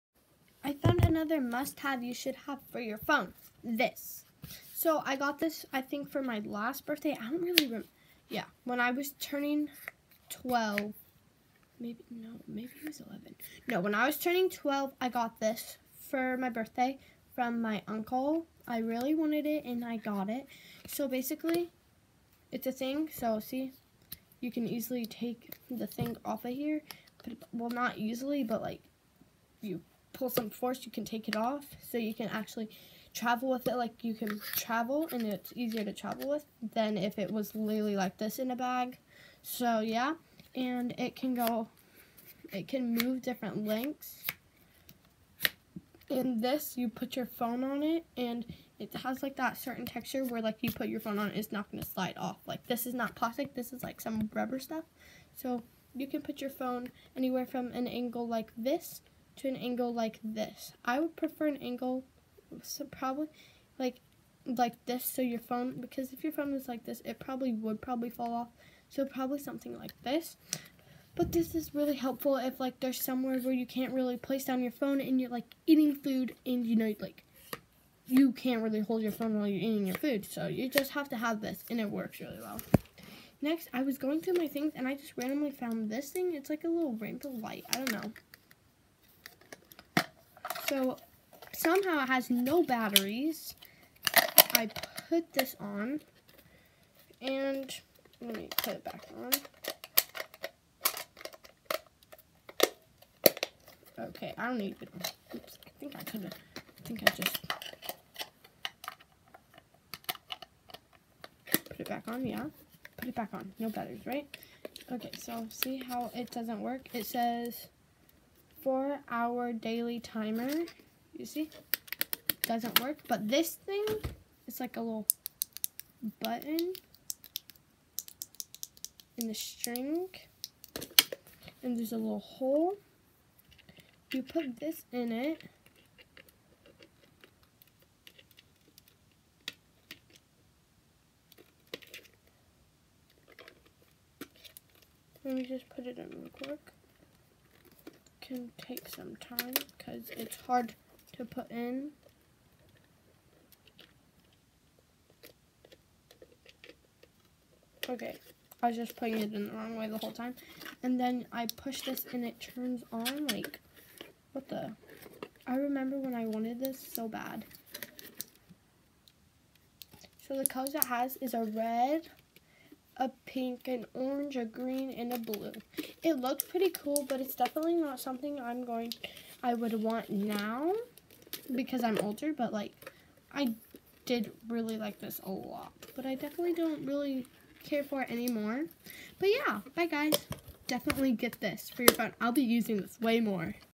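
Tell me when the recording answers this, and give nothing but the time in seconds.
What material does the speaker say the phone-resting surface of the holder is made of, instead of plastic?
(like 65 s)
54 s.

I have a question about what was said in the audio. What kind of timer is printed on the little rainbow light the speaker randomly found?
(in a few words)
4 hour daily timer.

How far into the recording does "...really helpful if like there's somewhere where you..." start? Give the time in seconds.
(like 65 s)
71 s.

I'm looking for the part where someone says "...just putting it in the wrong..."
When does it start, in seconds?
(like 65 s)
158 s.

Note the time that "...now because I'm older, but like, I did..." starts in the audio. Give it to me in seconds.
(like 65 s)
180 s.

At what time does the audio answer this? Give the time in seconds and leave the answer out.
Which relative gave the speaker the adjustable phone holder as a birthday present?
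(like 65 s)
17 s.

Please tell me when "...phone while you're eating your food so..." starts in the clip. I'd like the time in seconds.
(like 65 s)
79 s.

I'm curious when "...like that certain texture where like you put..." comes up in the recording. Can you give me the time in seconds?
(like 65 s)
49 s.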